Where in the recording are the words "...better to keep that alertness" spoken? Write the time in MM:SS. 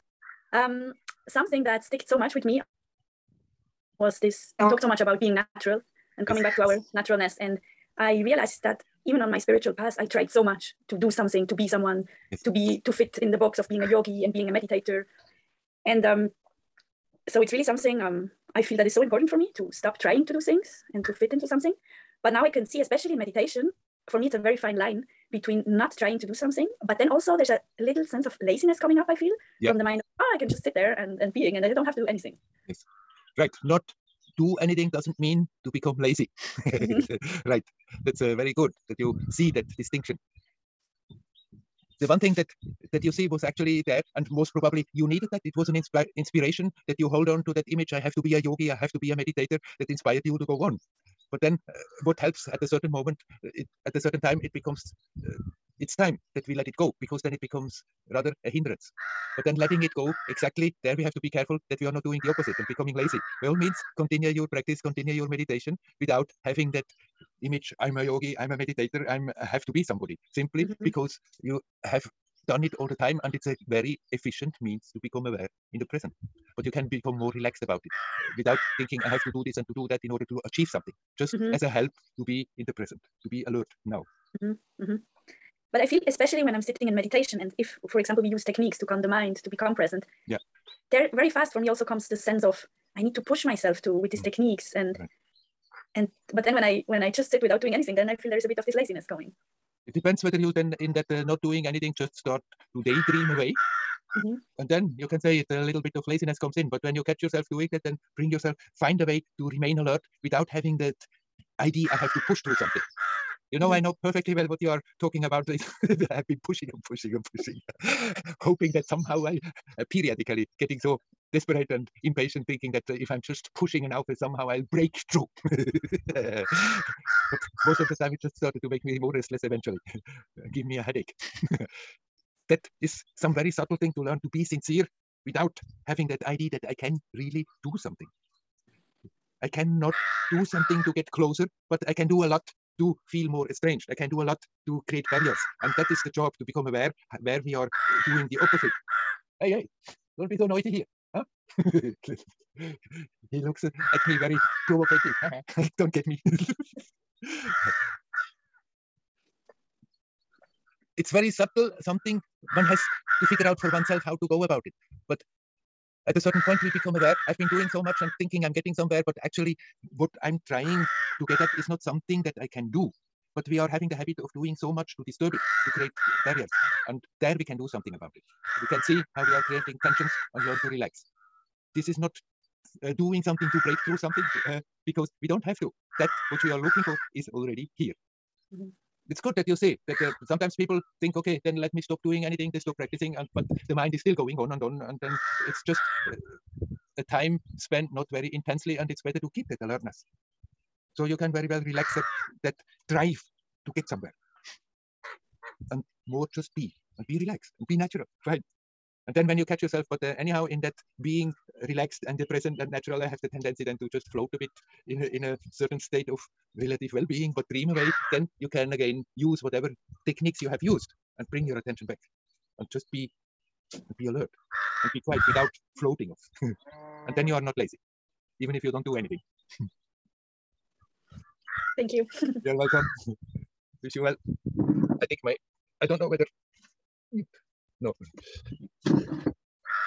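03:19.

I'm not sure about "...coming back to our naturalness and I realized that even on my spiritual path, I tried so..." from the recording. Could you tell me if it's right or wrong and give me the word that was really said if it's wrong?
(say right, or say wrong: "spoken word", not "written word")
right.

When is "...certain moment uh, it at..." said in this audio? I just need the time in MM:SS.
00:52.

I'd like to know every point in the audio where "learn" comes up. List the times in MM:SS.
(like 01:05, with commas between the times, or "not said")
02:14, 03:00.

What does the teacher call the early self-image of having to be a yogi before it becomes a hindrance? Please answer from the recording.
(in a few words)
inspiration.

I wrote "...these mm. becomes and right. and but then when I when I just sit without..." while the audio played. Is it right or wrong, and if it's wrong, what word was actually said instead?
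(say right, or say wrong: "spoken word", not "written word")
wrong: "techniques", not "becomes".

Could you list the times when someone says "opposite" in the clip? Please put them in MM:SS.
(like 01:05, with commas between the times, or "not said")
01:02, 02:28.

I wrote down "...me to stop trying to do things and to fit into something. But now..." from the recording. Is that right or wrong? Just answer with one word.
right.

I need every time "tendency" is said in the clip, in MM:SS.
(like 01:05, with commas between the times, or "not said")
03:33.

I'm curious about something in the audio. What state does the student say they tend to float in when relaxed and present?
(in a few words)
relative well-being.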